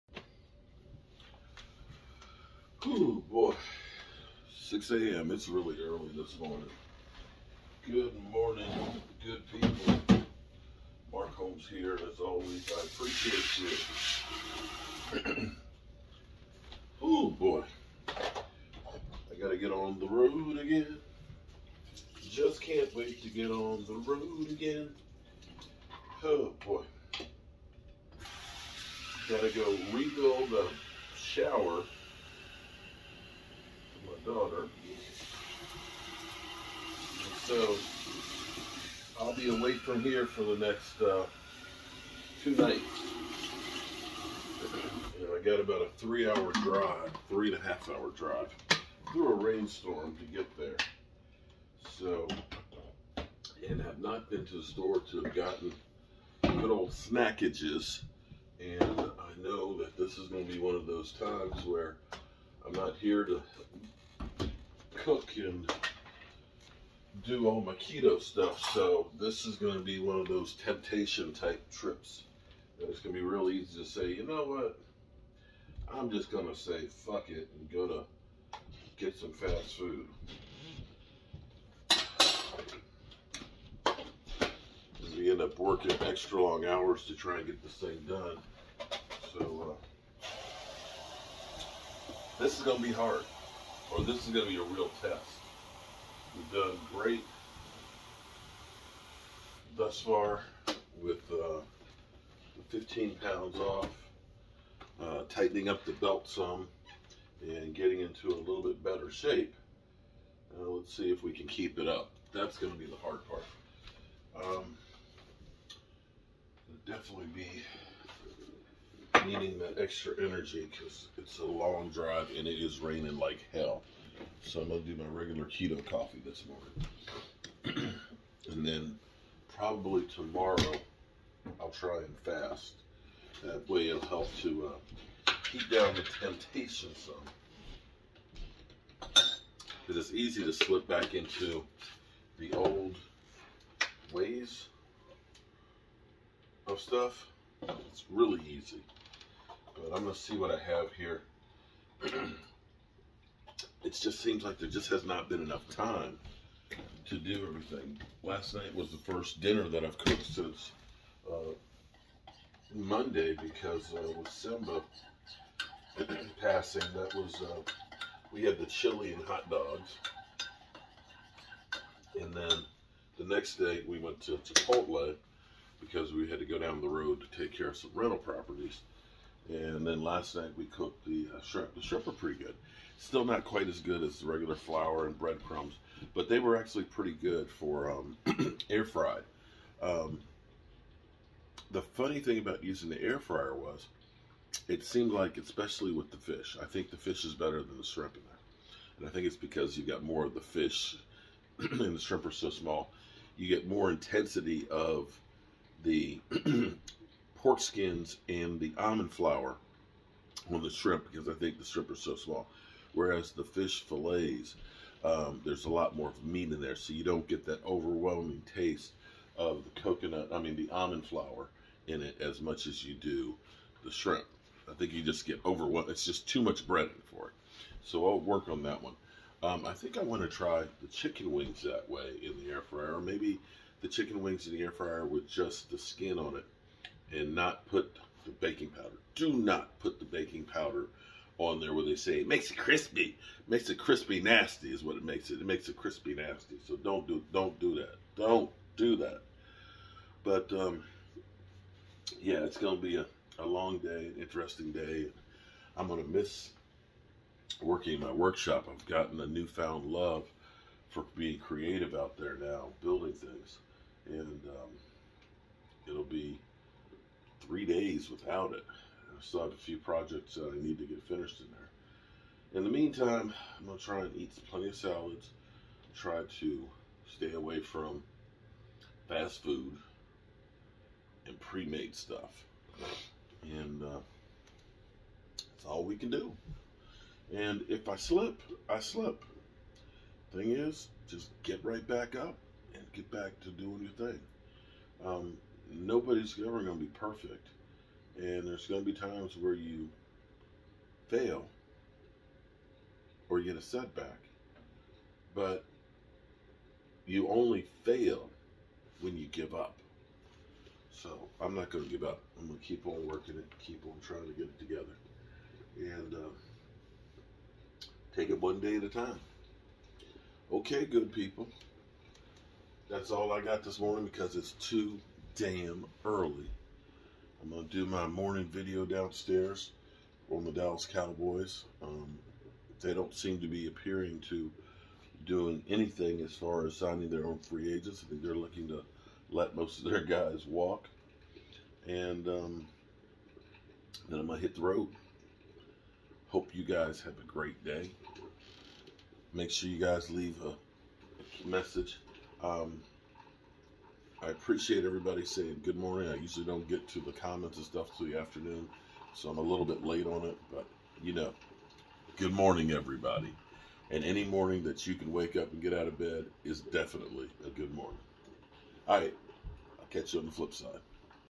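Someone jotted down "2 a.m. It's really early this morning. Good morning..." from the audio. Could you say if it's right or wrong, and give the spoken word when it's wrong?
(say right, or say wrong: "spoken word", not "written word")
wrong: "6", not "2".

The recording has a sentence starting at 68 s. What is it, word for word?
So this is going to be one of those temptation type trips.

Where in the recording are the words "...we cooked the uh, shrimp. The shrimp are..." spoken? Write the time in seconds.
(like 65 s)
180 s.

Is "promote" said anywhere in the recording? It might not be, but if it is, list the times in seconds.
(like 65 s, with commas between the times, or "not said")
not said.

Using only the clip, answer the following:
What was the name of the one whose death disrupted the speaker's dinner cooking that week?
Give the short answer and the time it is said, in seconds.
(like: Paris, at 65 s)
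Simba, at 164 s.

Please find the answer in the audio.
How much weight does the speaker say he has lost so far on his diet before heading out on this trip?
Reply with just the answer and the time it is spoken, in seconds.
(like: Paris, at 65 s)
15 pounds, at 102 s.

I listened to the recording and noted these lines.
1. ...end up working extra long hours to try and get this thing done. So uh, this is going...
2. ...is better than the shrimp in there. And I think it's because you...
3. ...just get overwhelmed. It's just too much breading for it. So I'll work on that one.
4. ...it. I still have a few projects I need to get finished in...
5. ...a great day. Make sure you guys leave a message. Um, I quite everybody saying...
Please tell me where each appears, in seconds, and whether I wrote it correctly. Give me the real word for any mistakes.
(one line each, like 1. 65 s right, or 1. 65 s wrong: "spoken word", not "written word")
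1. 85 s right
2. 197 s right
3. 225 s right
4. 268 s right
5. 347 s wrong: "appreciate", not "quite".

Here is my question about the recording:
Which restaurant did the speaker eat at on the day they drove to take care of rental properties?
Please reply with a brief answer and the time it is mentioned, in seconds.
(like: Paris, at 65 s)
Chipotle, at 174 s.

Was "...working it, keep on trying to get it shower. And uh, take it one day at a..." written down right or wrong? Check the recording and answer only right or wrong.
wrong.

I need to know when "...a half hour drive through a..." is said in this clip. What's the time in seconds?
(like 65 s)
47 s.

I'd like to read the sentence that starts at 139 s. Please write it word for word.
Because it's easy to slip back into the old ways of stuff.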